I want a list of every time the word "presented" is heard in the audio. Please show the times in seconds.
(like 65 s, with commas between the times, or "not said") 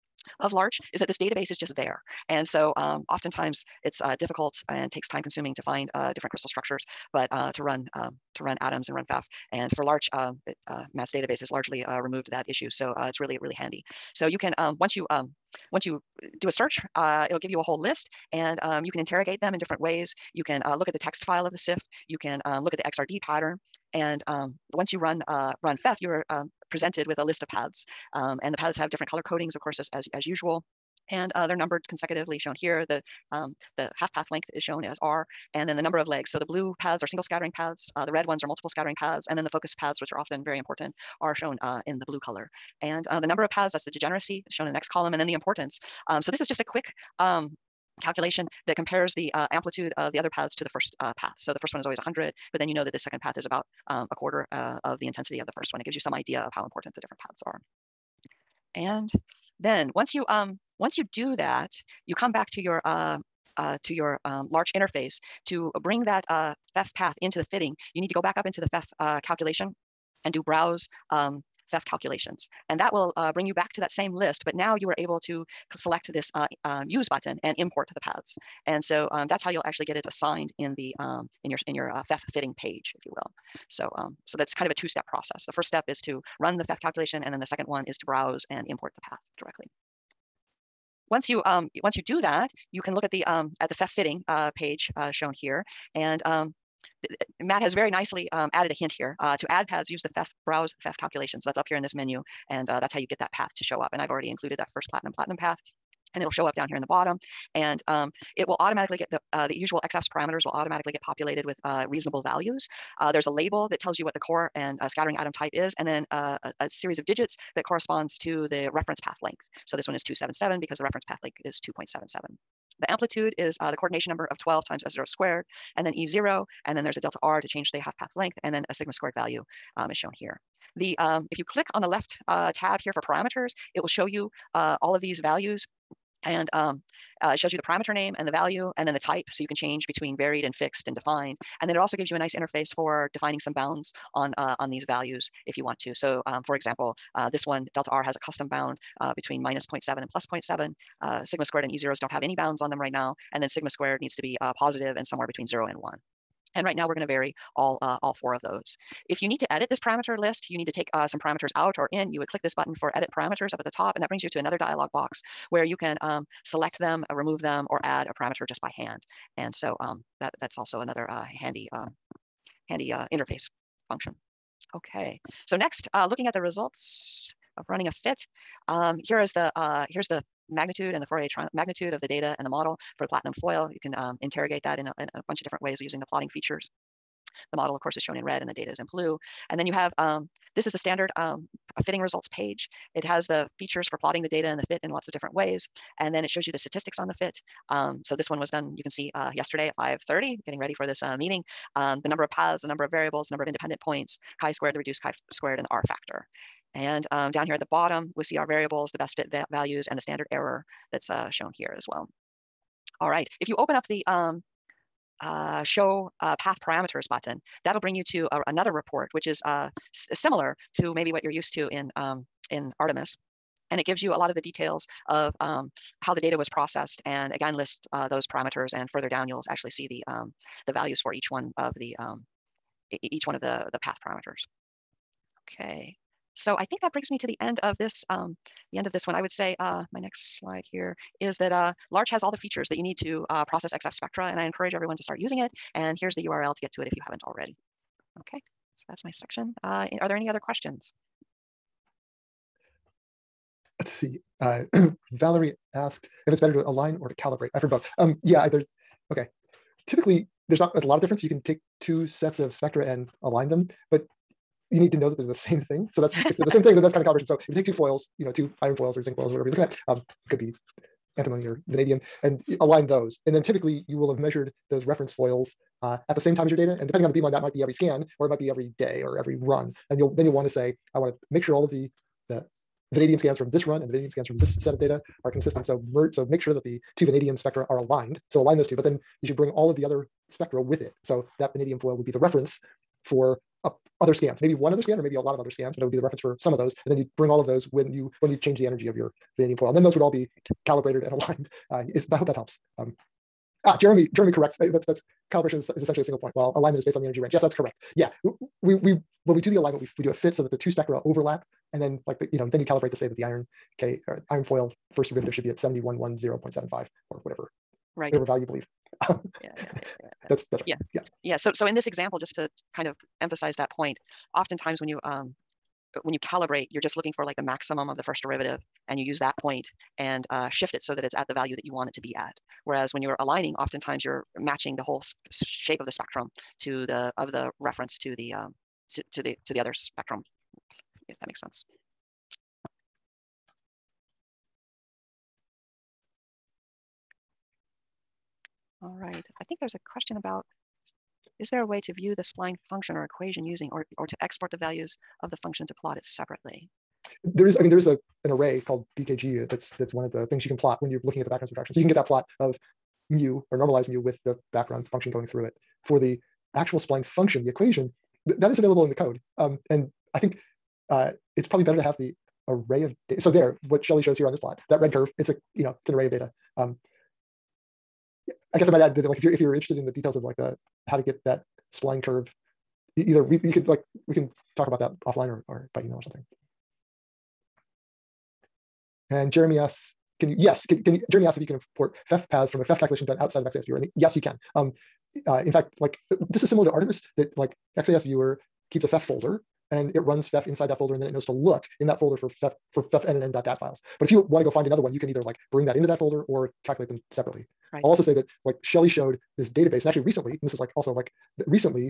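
26 s.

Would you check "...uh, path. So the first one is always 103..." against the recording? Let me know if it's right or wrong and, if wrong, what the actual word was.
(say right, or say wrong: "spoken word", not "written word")
wrong: "100", not "103".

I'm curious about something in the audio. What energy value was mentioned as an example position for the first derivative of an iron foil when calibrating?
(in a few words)
7110.75.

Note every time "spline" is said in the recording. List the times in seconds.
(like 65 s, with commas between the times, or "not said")
352 s, 366 s, 381 s.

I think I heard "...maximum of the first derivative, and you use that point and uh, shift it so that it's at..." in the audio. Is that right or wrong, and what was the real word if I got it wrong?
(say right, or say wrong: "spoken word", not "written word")
right.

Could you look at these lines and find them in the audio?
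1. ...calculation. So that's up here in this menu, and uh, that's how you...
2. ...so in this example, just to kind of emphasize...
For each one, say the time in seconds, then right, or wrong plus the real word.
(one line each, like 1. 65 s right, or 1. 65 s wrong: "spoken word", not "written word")
1. 100 s right
2. 321 s right.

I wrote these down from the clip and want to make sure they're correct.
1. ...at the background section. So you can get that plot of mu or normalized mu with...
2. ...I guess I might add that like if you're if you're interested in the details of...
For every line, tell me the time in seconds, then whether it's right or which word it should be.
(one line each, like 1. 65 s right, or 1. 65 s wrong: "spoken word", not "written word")
1. 361 s wrong: "subtraction", not "section"
2. 378 s right.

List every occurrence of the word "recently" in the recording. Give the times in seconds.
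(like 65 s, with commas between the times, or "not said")
410 s.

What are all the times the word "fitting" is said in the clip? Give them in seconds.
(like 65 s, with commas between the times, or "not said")
67 s, 82 s, 93 s, 191 s.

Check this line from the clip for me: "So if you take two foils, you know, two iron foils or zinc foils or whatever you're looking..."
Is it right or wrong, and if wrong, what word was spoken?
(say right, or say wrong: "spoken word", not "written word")
right.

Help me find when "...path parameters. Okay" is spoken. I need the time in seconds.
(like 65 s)
233 s.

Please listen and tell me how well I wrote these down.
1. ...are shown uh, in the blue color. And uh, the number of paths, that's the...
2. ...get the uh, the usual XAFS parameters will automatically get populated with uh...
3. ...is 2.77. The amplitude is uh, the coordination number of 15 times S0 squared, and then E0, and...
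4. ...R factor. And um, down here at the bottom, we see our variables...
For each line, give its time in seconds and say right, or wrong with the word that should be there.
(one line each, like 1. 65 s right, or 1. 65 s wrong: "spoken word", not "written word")
1. 41 s right
2. 108 s right
3. 121 s wrong: "12", not "15"
4. 205 s right.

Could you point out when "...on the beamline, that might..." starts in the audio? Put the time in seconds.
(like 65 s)
277 s.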